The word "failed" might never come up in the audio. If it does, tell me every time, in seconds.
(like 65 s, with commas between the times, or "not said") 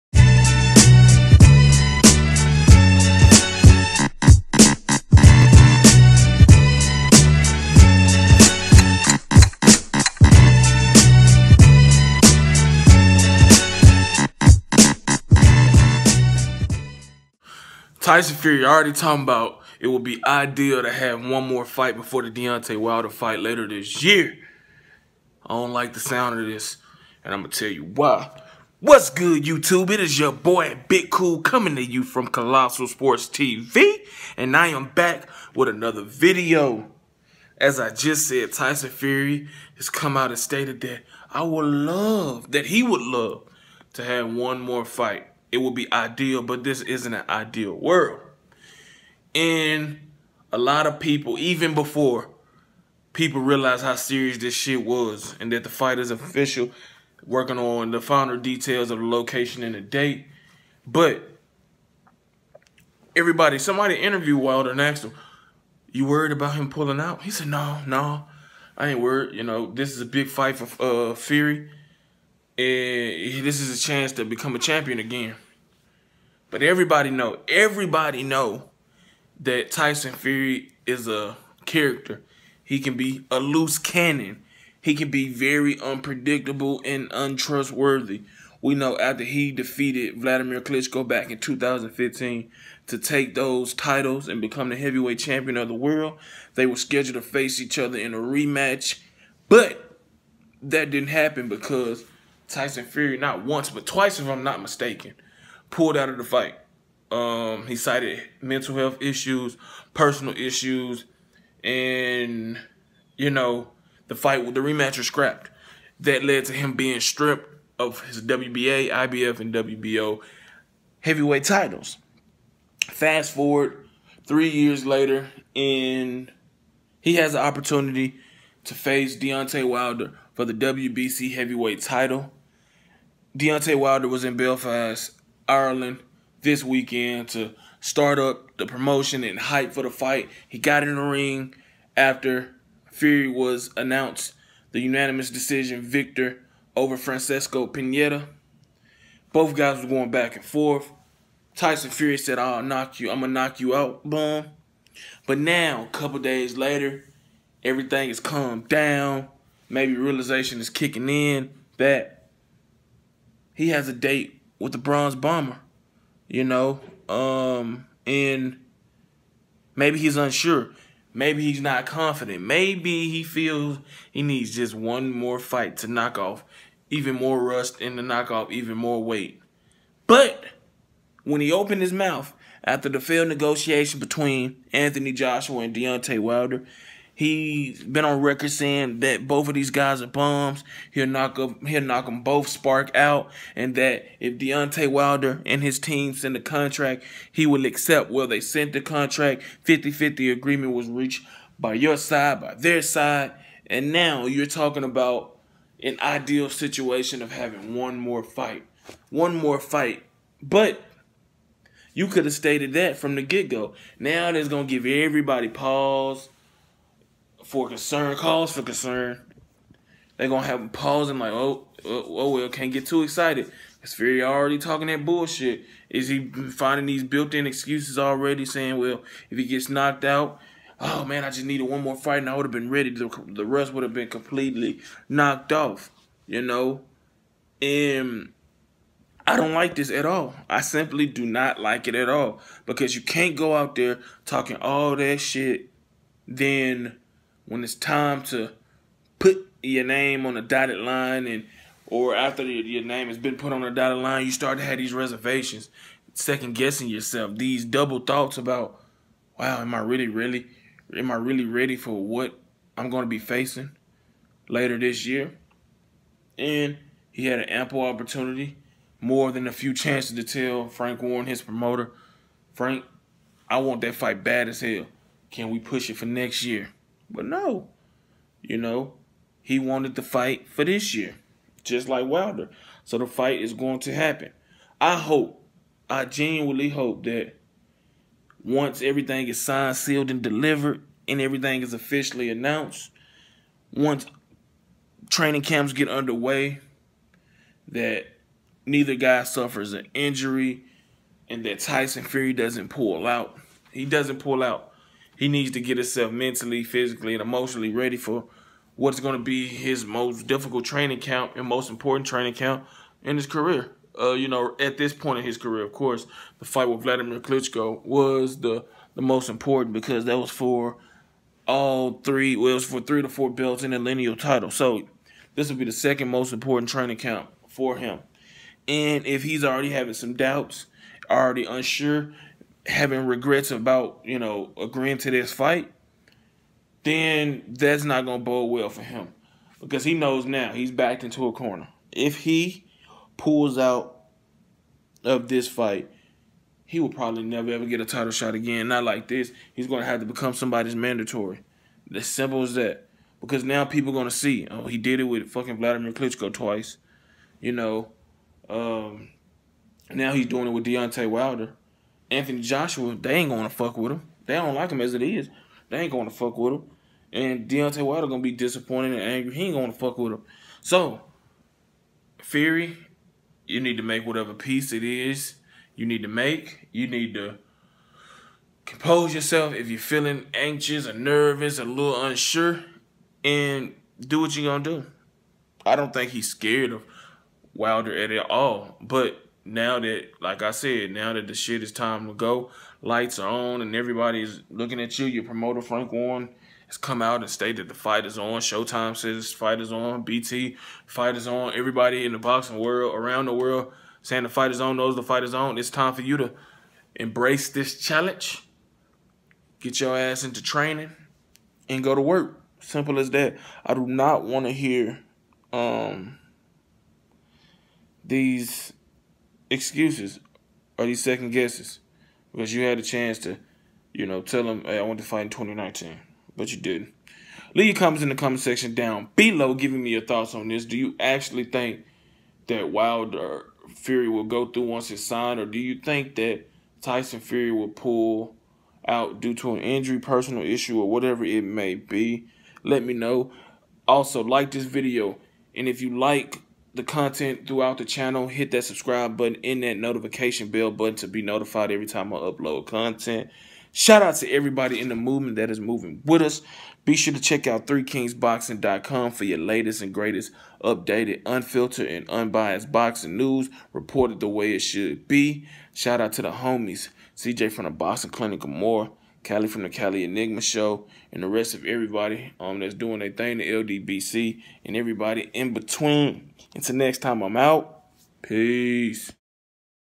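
182 s.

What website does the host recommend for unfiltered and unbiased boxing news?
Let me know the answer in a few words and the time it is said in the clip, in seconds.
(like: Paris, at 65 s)
3kingsboxing.com, at 457 s.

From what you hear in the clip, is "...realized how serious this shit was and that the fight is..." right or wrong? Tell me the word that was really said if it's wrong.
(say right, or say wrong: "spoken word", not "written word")
right.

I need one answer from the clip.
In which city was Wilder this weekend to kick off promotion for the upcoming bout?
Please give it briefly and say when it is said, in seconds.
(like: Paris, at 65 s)
Belfast, at 134 s.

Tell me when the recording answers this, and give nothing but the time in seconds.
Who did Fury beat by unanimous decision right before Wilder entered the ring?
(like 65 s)
146 s.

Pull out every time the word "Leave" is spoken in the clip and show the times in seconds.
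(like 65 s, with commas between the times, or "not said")
427 s.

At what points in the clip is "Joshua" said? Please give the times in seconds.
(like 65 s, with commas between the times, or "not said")
185 s, 362 s.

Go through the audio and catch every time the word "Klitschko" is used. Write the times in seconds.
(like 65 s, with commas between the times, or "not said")
90 s, 317 s, 355 s.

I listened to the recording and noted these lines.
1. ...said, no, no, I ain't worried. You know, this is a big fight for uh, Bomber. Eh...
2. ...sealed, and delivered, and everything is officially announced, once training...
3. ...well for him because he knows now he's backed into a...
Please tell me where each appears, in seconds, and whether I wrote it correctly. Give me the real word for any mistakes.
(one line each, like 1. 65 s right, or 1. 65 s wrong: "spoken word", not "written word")
1. 67 s wrong: "Fury", not "Bomber"
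2. 289 s right
3. 338 s right.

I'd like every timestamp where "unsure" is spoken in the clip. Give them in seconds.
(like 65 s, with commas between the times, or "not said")
170 s, 331 s, 382 s.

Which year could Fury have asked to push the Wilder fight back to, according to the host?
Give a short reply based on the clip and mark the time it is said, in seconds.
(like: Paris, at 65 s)
2019, at 425 s.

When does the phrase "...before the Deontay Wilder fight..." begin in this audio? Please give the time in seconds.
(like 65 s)
21 s.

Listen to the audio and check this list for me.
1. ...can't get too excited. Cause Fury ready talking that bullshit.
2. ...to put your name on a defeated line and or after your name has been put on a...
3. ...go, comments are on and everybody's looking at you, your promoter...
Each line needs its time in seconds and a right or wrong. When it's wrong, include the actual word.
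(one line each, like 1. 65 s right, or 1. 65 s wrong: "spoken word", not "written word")
1. 222 s wrong: "already", not "ready"
2. 248 s wrong: "dotted", not "defeated"
3. 392 s wrong: "lights", not "comments".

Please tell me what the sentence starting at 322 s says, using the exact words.
Well, it was for three to four belts and a lineal title.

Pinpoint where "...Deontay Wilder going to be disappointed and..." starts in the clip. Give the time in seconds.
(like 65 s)
367 s.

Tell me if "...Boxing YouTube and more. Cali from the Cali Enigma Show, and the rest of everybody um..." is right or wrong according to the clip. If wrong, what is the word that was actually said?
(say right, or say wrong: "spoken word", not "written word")
wrong: "Clinic", not "YouTube".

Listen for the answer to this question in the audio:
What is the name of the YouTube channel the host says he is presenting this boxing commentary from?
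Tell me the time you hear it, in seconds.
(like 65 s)
32 s.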